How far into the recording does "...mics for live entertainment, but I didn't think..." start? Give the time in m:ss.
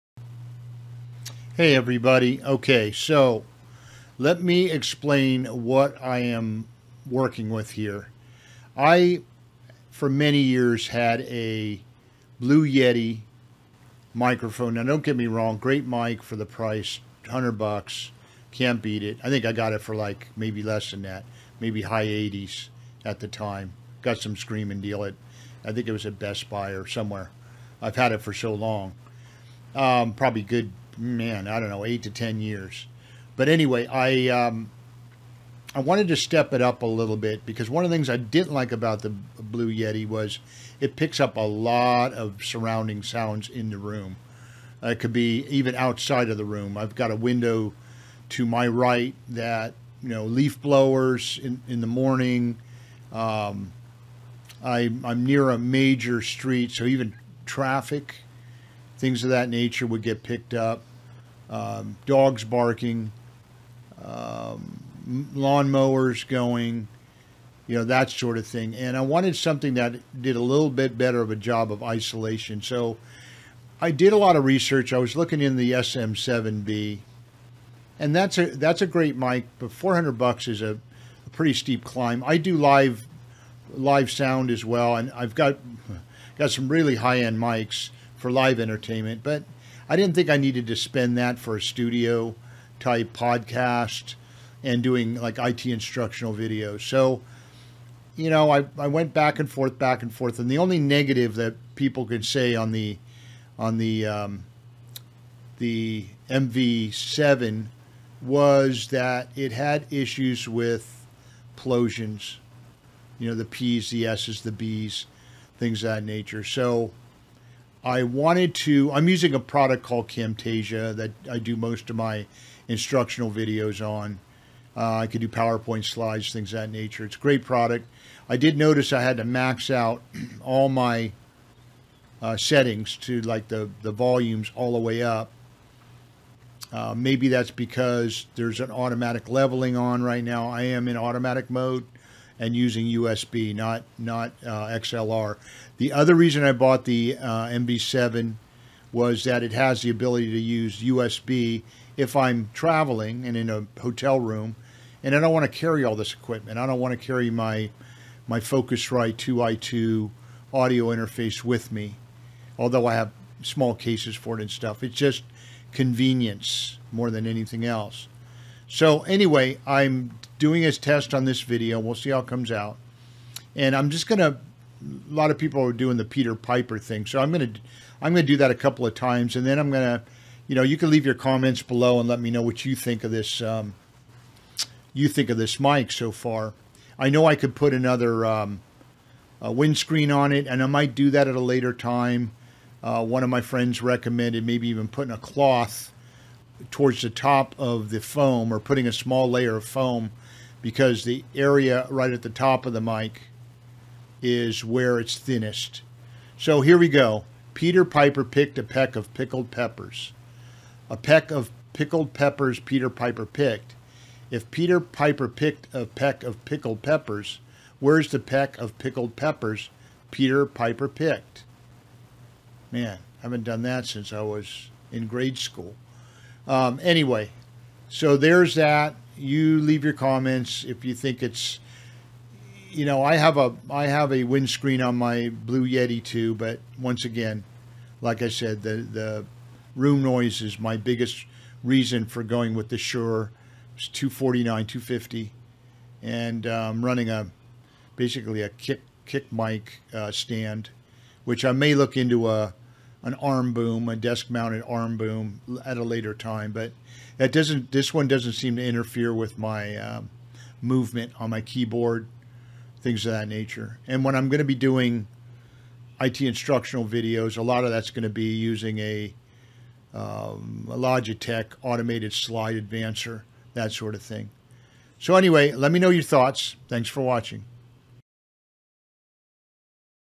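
1:27.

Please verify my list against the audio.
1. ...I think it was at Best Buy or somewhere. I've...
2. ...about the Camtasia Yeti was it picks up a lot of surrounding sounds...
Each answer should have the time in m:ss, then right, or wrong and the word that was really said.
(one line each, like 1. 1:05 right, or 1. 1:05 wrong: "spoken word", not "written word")
1. 0:25 right
2. 0:38 wrong: "Blue", not "Camtasia".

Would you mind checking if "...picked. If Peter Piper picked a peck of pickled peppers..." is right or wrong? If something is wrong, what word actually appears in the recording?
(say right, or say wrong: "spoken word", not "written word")
right.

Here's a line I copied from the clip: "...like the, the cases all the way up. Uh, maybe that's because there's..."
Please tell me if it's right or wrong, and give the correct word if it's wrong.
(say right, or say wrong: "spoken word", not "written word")
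wrong: "volumes", not "cases".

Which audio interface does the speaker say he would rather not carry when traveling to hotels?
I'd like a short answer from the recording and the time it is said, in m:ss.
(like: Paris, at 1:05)
Focusrite 2i2, at 2:38.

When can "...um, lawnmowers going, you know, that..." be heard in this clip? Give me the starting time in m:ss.
1:04.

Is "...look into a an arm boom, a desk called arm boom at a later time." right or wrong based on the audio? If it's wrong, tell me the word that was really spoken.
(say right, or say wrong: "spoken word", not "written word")
wrong: "mounted", not "called".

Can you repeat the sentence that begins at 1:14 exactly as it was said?
I was looking in the SM7B, and that's a that's a great mic, but 400 bucks is a, a pretty steep climb.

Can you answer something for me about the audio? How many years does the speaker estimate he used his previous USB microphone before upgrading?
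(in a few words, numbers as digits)
8 to 10 years.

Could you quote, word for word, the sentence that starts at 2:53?
And I'm just going to, a lot of people are doing the Peter Piper thing.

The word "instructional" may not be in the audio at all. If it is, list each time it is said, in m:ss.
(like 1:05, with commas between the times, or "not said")
1:35, 2:02, 4:26.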